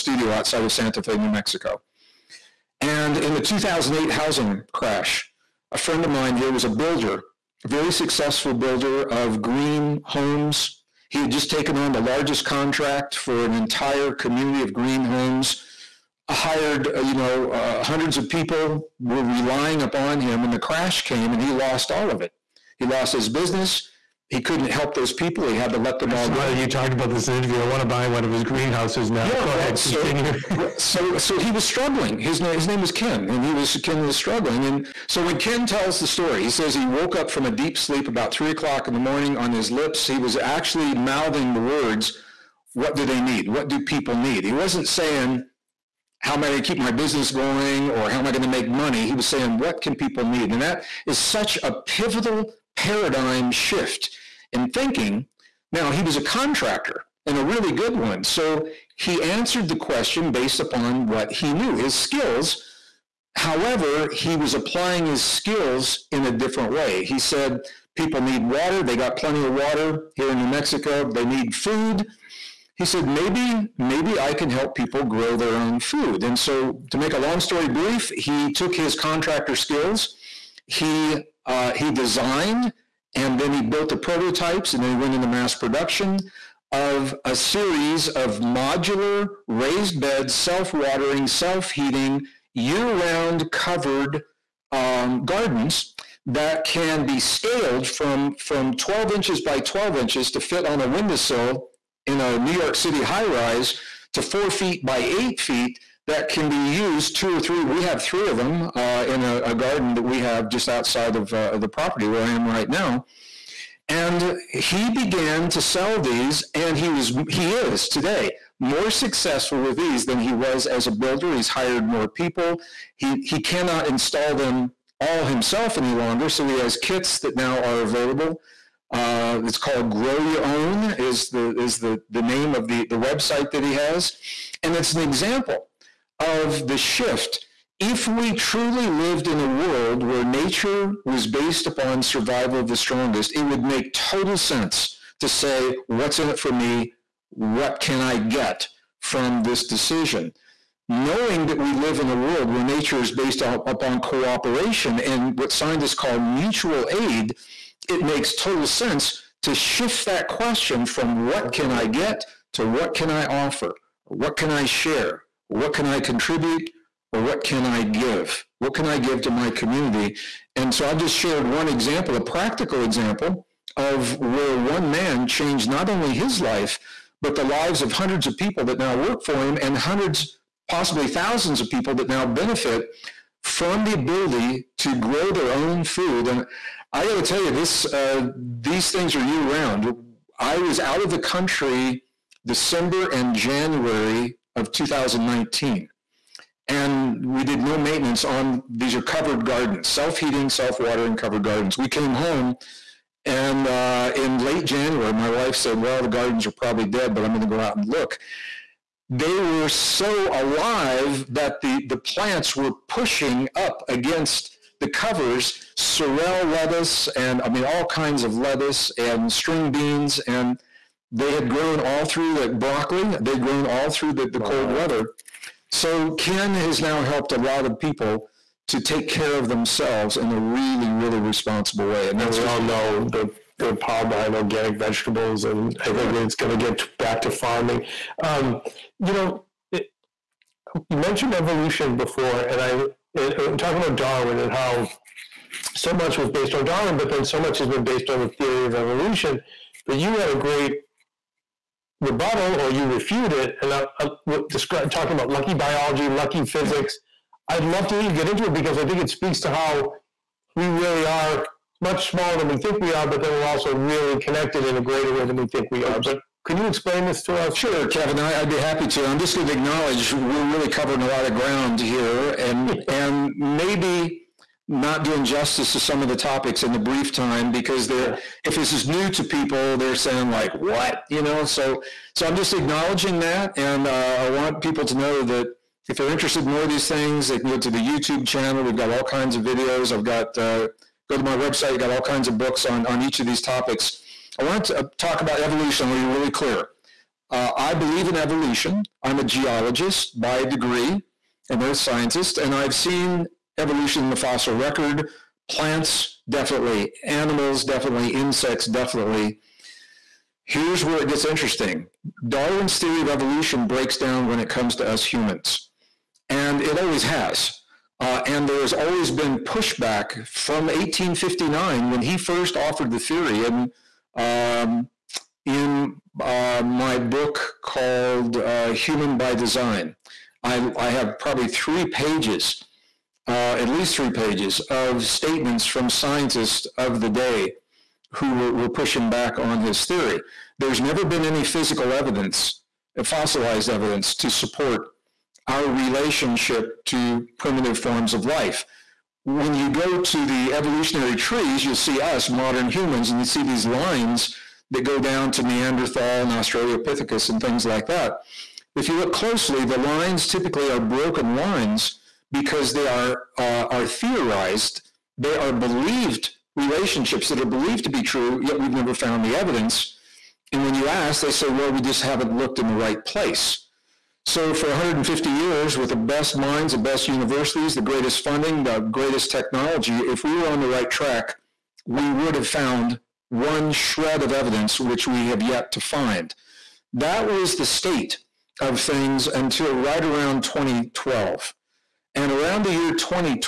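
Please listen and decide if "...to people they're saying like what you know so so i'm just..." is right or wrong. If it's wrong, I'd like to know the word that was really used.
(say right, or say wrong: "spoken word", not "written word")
right.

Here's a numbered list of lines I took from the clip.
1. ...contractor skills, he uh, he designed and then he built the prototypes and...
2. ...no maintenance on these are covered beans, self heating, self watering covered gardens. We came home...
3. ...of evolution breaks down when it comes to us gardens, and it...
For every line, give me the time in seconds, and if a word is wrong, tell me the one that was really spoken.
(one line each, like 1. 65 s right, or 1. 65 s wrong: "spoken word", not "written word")
1. 78 s right
2. 197 s wrong: "gardens", not "beans"
3. 313 s wrong: "humans", not "gardens".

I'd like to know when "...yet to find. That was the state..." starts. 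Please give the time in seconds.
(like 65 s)
385 s.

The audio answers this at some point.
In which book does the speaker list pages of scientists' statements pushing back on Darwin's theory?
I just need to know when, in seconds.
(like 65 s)
328 s.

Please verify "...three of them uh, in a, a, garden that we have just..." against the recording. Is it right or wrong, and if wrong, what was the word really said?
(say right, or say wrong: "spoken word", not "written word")
right.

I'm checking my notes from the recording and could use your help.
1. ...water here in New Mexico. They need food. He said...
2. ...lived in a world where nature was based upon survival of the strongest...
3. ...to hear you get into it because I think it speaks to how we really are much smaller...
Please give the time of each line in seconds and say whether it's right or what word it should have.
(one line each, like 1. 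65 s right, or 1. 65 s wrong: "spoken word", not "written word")
1. 69 s right
2. 138 s right
3. 257 s right.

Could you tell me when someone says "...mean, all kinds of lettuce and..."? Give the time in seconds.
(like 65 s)
217 s.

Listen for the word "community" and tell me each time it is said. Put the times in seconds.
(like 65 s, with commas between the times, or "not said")
14 s, 169 s.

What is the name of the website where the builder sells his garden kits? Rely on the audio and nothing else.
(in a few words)
Grow Your Own.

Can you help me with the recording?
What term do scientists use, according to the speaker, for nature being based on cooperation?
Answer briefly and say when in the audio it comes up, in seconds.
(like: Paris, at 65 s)
mutual aid, at 156 s.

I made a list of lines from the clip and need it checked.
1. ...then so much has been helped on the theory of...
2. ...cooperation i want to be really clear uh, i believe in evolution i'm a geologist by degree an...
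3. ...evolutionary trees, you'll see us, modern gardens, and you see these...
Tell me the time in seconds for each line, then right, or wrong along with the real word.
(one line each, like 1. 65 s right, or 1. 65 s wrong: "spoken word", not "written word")
1. 247 s wrong: "based", not "helped"
2. 295 s wrong: "evolution", not "cooperation"
3. 350 s wrong: "humans", not "gardens".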